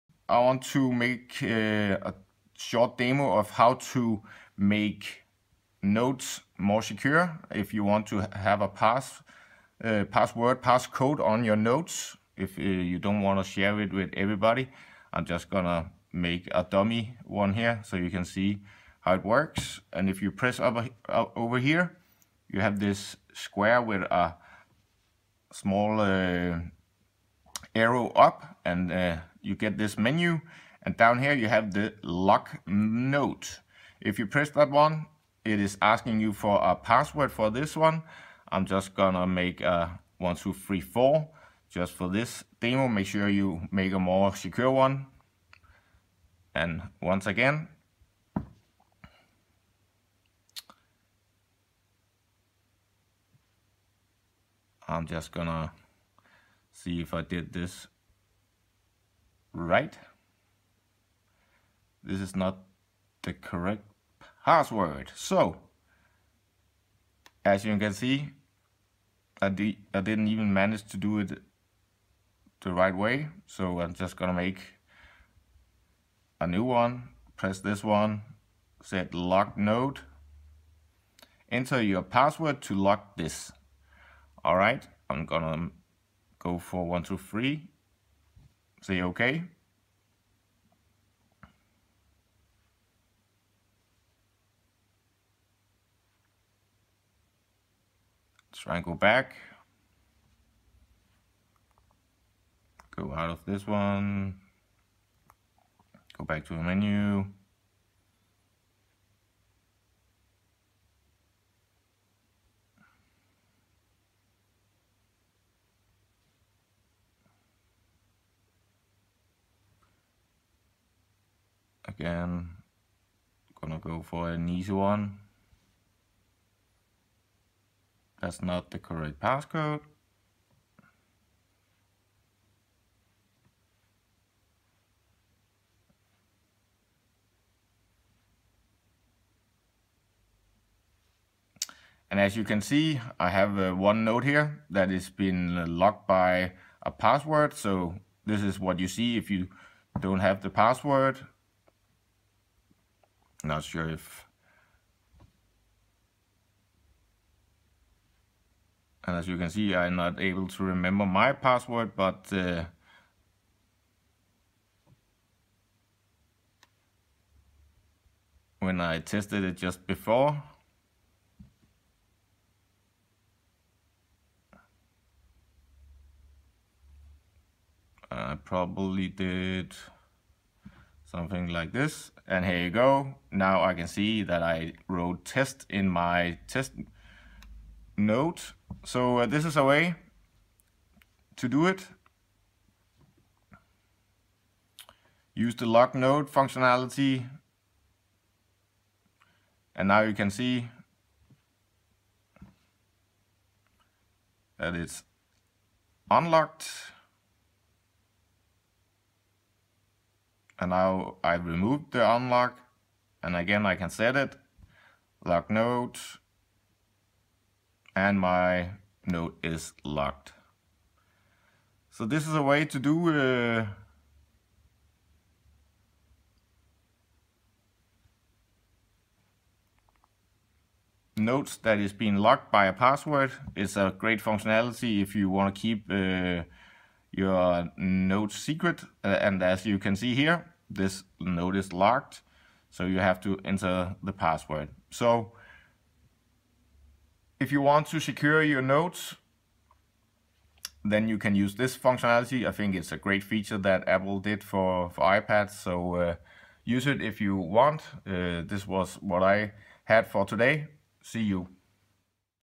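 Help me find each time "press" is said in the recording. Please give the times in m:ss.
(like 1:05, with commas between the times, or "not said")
0:20, 0:34, 1:17.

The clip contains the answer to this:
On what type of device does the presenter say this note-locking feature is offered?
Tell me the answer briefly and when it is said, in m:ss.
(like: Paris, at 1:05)
iPads, at 4:15.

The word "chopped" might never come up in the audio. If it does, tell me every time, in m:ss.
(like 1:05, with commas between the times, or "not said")
not said.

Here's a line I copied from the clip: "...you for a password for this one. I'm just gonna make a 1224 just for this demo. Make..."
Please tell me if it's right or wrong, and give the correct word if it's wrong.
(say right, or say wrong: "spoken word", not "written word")
wrong: "1234", not "1224".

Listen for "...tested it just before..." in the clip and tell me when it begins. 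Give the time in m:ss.
2:48.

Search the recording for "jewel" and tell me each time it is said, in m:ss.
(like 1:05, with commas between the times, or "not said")
not said.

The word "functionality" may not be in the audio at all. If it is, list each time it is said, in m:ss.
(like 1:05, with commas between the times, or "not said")
3:16, 3:54, 4:11.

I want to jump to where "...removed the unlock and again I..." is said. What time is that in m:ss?
3:31.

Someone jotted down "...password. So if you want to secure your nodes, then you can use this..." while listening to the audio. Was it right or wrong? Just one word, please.
right.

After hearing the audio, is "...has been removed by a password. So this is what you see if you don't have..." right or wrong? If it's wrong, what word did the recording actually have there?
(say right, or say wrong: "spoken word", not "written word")
wrong: "locked", not "removed".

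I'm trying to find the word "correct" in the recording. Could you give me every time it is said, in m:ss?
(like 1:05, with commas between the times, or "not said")
1:03, 2:08.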